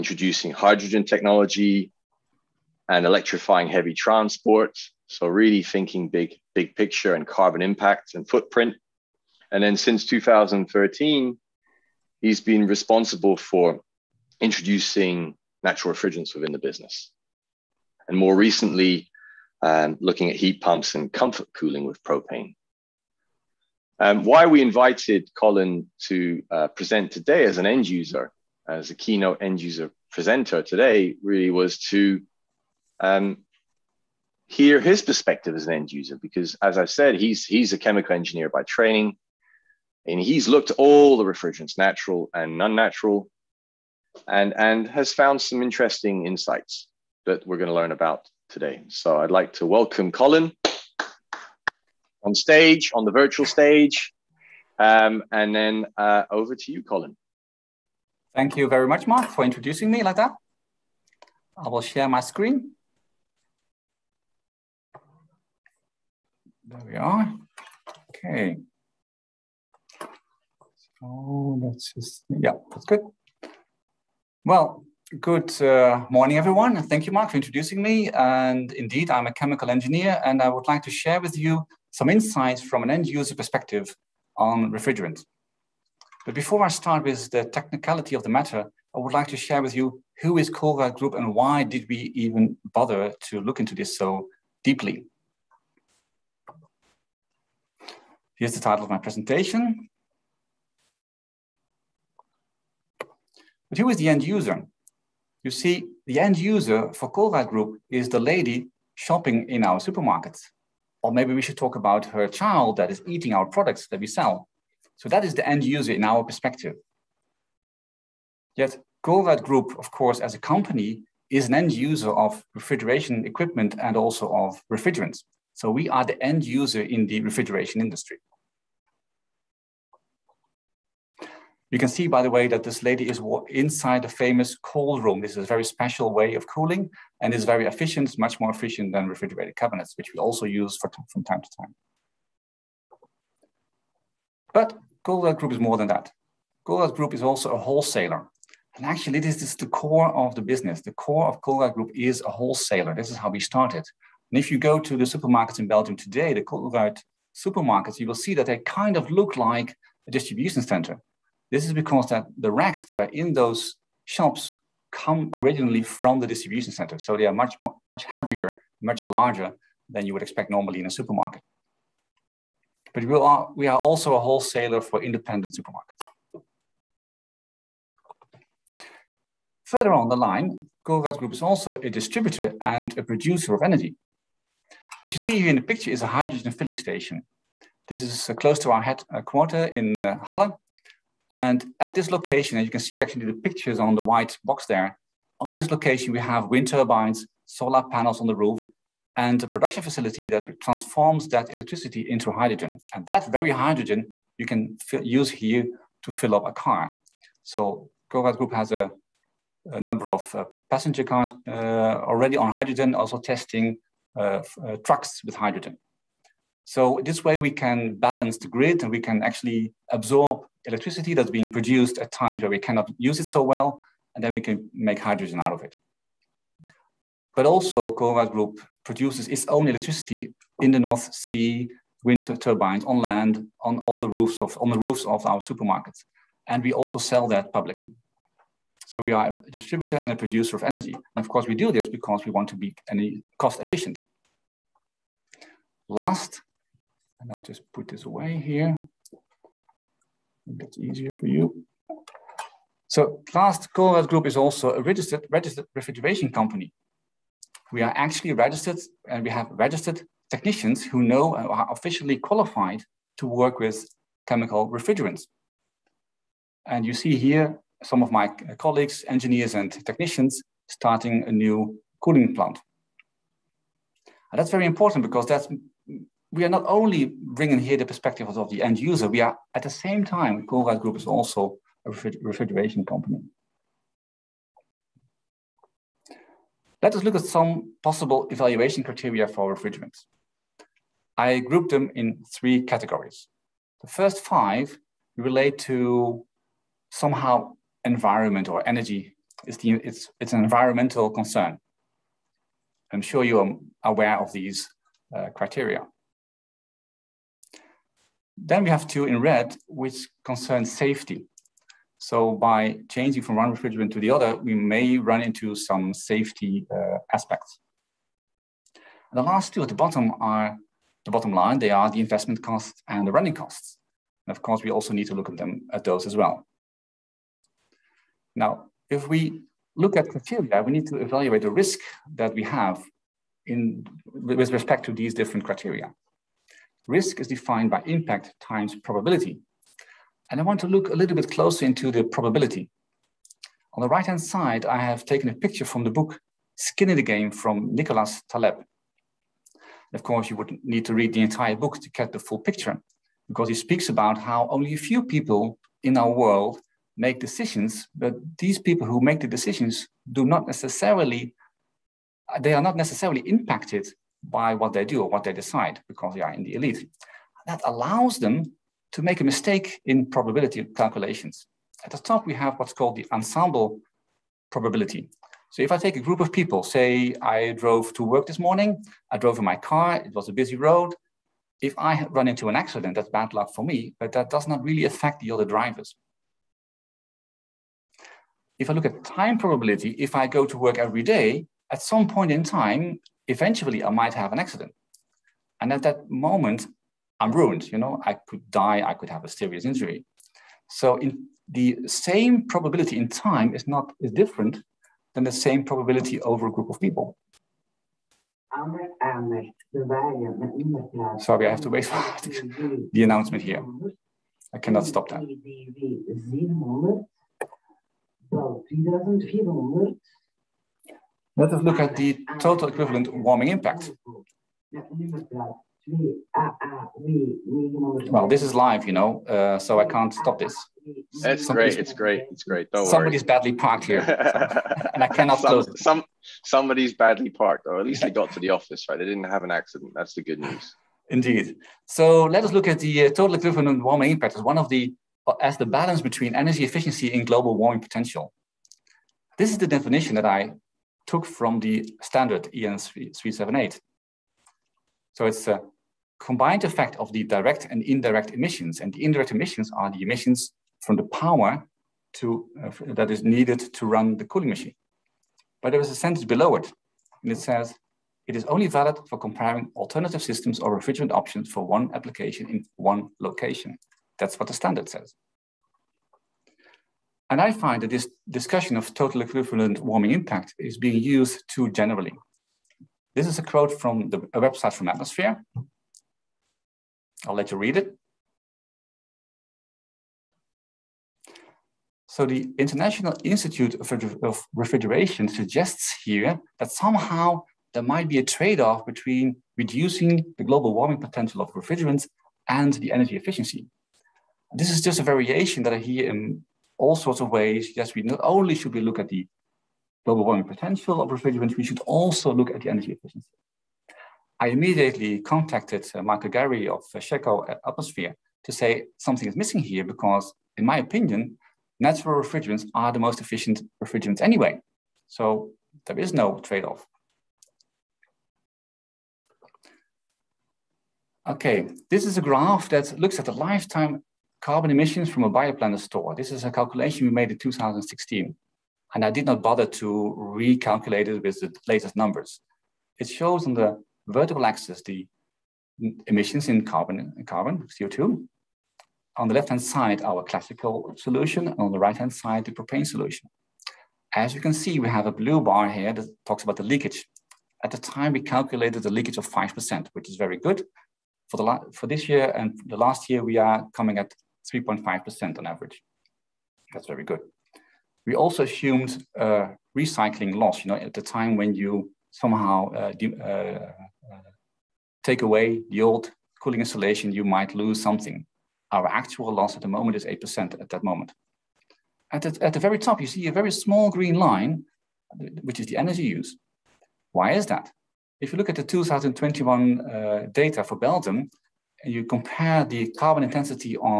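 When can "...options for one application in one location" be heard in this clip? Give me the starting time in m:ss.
7:51.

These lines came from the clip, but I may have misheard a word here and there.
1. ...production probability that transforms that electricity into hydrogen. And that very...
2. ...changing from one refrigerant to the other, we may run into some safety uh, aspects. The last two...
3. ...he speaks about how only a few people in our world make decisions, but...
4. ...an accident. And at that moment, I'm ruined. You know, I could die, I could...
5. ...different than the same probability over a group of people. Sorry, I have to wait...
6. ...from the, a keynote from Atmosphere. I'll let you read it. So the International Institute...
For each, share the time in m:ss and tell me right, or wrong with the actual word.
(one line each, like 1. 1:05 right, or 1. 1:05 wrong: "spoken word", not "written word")
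1. 3:19 wrong: "facility", not "probability"
2. 5:12 right
3. 5:53 right
4. 6:34 right
5. 6:44 right
6. 8:03 wrong: "website", not "keynote".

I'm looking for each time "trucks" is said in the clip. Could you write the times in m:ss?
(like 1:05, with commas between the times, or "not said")
3:34.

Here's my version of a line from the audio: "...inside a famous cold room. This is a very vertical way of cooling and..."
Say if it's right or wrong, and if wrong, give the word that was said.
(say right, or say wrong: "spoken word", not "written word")
wrong: "special", not "vertical".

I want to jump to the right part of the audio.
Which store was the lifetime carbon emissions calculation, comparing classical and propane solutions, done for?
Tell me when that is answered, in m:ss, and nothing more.
8:55.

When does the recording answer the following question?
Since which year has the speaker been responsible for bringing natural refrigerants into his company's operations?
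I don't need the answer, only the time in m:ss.
0:10.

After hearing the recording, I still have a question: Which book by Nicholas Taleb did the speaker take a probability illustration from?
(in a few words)
Skin in the Game.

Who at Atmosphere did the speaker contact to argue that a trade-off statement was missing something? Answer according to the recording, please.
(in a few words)
Michael Garry.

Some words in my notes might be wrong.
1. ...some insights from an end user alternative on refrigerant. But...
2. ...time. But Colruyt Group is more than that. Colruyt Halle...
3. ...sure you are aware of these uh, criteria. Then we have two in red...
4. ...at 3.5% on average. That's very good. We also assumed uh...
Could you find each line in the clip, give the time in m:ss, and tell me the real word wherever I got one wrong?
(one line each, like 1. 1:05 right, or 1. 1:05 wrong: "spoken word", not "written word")
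1. 1:21 wrong: "perspective", not "alternative"
2. 2:21 wrong: "Group", not "Halle"
3. 5:03 right
4. 9:23 right.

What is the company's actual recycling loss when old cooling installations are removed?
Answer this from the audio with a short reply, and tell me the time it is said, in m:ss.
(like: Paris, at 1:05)
8%, at 9:40.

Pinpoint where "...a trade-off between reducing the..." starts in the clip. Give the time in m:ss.
8:18.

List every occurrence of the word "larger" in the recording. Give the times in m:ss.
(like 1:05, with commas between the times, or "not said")
2:49.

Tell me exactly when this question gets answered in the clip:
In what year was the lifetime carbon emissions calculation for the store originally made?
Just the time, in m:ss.
8:57.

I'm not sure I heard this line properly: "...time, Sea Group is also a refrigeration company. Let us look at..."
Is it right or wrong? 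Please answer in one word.
wrong.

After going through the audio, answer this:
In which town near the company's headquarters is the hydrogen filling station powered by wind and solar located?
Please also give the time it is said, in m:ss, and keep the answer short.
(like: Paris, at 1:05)
Halle, at 3:10.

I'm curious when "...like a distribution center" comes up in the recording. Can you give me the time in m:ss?
2:39.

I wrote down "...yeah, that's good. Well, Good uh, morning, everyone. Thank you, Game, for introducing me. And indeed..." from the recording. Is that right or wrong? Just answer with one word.
wrong.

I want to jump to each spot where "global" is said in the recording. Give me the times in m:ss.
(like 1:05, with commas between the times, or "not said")
7:27, 8:20, 8:30.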